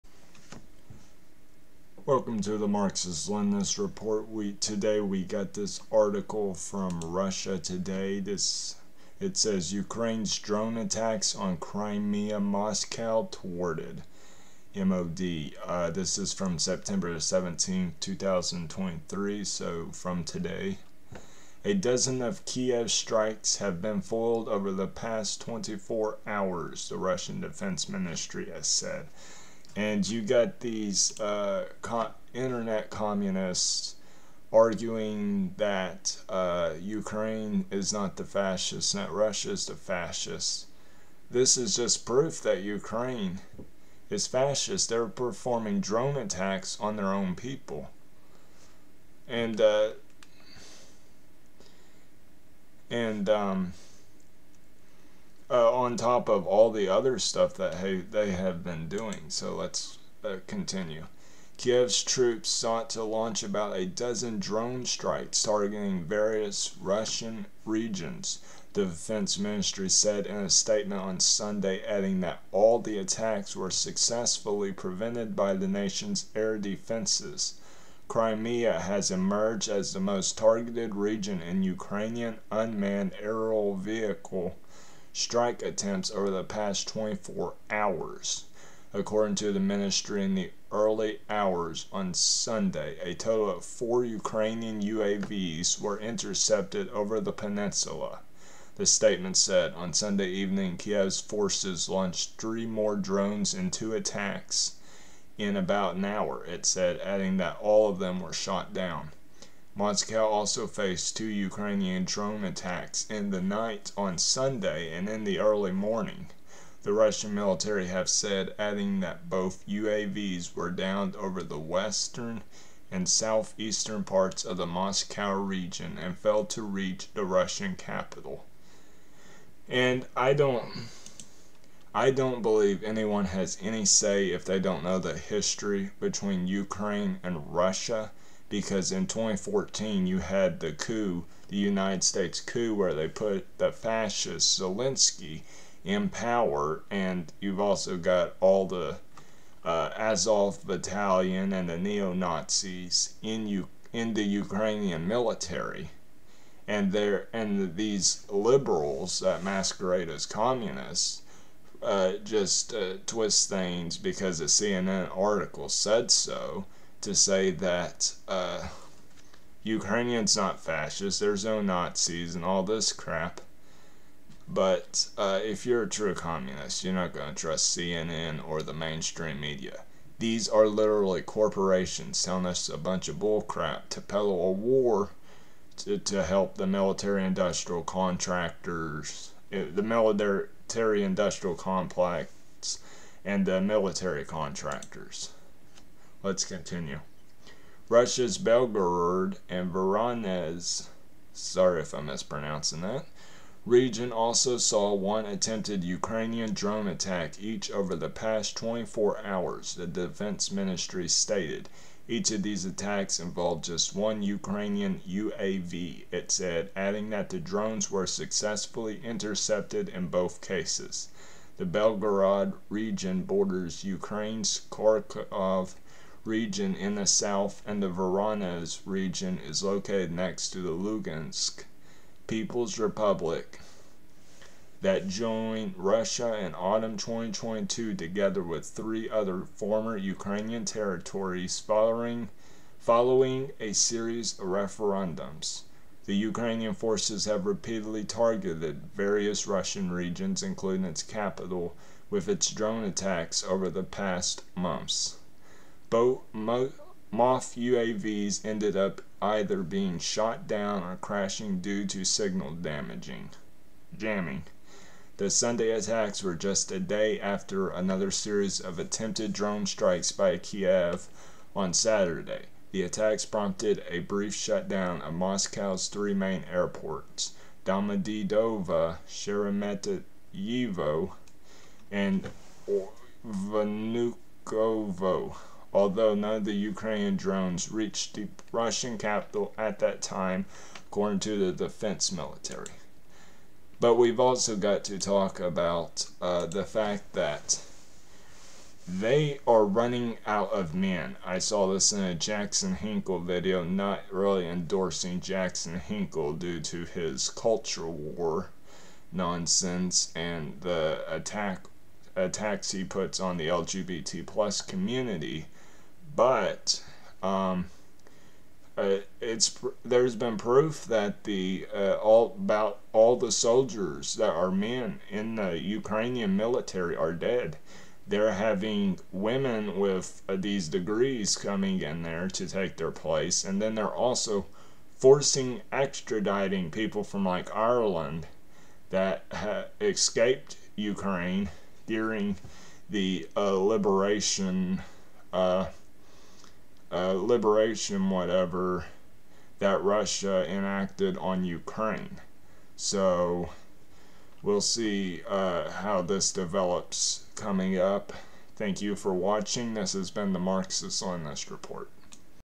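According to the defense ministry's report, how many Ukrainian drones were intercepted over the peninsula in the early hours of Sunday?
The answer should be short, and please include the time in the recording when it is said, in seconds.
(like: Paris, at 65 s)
4, at 93 s.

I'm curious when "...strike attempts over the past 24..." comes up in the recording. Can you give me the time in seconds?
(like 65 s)
85 s.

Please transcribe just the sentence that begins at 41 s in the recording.
This is just proof that Ukraine is fascist.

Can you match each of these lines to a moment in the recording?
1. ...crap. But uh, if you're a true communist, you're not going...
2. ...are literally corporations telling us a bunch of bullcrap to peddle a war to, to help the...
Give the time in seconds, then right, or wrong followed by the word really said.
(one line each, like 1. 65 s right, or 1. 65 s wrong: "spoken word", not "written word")
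1. 172 s right
2. 180 s right.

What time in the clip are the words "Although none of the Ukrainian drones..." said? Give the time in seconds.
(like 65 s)
285 s.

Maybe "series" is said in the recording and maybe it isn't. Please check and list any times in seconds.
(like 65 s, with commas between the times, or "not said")
243 s, 268 s.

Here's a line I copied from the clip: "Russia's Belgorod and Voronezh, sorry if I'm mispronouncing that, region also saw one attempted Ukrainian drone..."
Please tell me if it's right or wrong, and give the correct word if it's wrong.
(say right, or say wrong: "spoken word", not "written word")
right.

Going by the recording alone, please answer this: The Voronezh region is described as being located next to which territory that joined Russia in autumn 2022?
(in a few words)
Lugansk People's Republic.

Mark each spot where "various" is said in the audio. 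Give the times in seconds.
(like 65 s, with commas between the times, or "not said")
66 s, 248 s.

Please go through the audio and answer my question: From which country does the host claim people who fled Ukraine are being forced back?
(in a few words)
Ireland.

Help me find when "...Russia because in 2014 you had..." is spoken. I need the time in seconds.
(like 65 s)
137 s.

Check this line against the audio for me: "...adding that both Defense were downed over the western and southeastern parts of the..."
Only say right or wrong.
wrong.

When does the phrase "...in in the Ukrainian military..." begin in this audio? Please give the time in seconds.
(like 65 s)
153 s.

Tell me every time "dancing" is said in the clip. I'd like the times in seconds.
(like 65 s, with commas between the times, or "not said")
not said.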